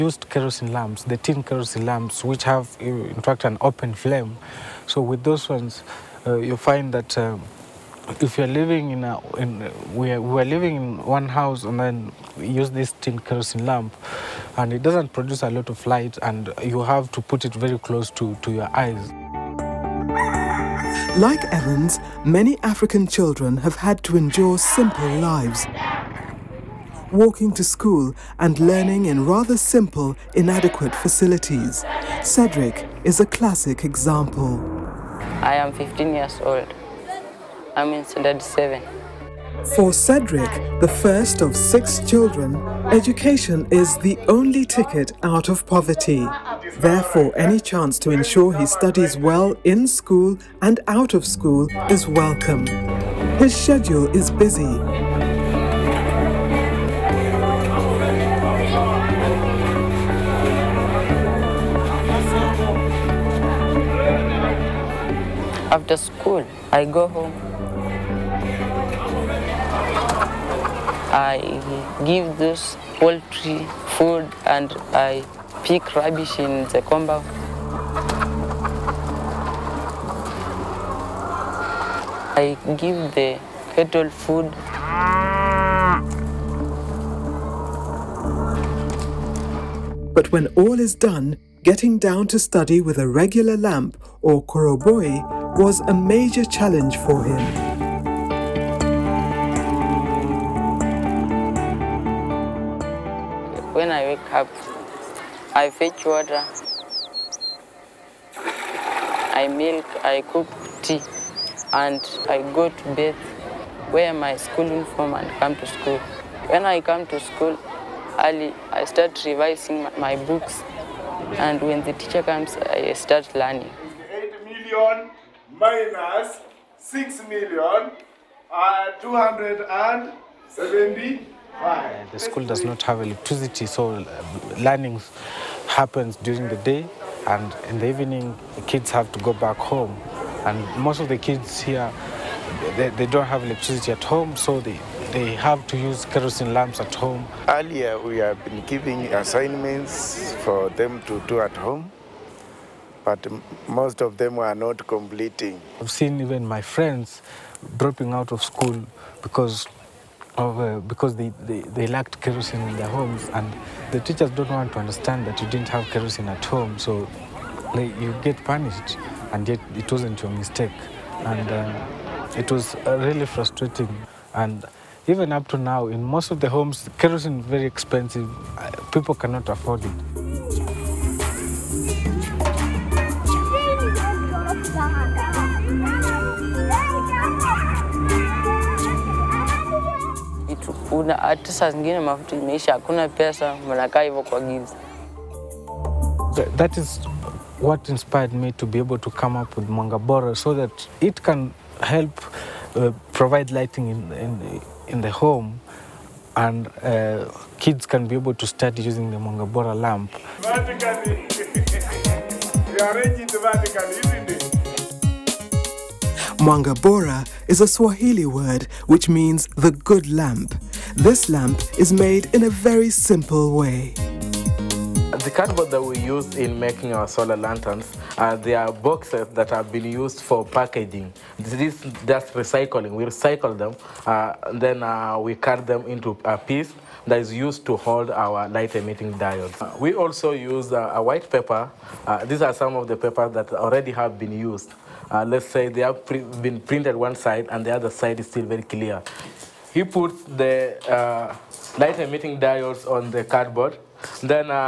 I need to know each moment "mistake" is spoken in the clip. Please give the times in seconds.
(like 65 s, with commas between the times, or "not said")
170 s.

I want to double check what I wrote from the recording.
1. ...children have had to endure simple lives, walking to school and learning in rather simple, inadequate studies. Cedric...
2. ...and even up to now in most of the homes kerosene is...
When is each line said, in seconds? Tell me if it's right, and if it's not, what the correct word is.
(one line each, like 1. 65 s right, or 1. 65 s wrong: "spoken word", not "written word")
1. 23 s wrong: "facilities", not "studies"
2. 174 s right.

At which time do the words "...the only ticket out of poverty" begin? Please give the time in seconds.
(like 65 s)
43 s.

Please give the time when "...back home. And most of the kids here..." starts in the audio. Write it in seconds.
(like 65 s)
139 s.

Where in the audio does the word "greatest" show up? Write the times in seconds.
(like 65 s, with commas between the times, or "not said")
not said.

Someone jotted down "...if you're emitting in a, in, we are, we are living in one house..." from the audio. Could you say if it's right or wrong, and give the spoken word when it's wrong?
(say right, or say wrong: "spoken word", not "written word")
wrong: "living", not "emitting".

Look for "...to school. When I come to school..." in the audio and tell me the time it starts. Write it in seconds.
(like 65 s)
115 s.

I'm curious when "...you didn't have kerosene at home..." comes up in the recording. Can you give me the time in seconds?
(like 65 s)
165 s.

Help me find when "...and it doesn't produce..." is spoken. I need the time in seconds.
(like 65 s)
14 s.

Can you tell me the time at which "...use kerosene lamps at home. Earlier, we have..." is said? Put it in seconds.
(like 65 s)
145 s.